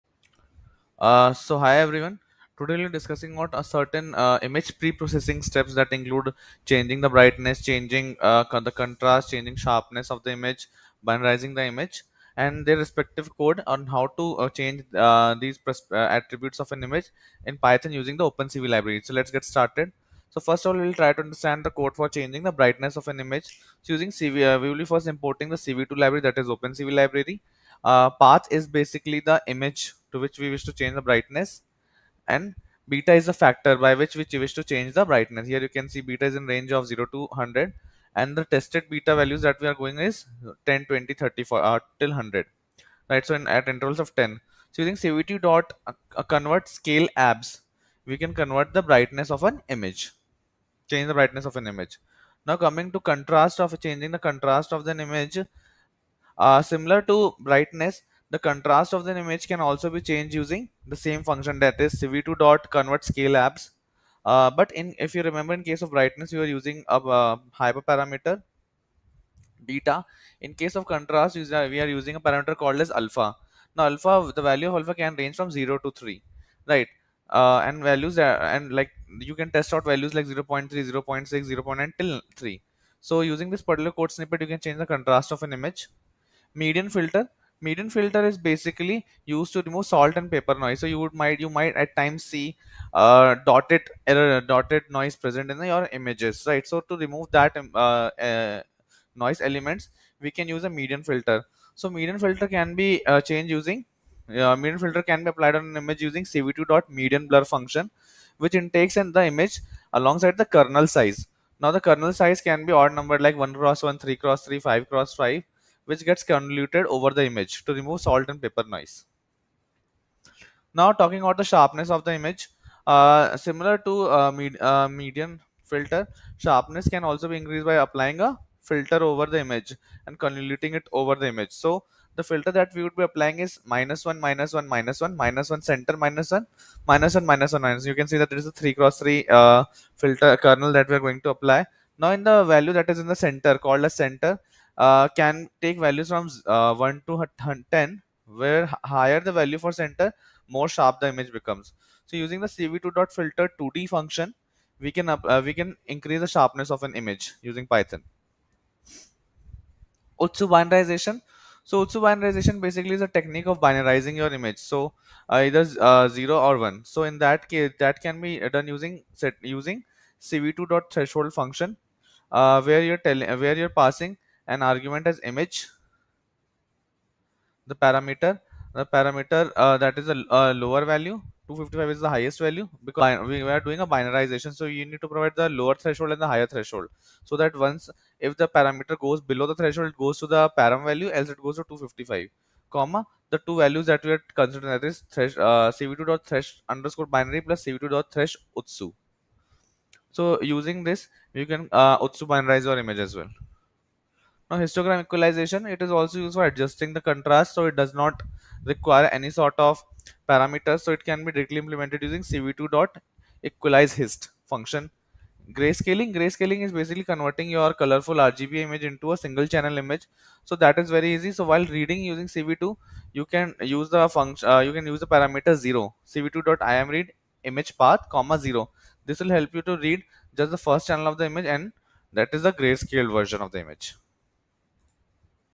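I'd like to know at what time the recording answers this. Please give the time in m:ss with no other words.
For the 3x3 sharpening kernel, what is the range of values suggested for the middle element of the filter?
2:26.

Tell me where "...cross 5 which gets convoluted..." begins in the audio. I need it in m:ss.
1:54.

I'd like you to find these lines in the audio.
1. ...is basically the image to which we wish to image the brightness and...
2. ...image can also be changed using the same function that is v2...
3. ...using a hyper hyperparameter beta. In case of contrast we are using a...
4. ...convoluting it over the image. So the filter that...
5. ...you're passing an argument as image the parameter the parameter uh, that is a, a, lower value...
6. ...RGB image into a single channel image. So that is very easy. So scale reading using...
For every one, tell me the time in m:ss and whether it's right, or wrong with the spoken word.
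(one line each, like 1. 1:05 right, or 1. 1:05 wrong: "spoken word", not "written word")
1. 0:28 wrong: "change", not "image"
2. 0:59 right
3. 1:06 right
4. 2:10 right
5. 2:53 right
6. 3:38 wrong: "while", not "scale".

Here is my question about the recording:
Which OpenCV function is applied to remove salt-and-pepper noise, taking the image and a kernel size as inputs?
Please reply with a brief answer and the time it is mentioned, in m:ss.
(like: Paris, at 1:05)
cv median blur, at 1:46.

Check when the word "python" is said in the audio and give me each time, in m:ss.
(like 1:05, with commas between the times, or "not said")
0:17, 2:37.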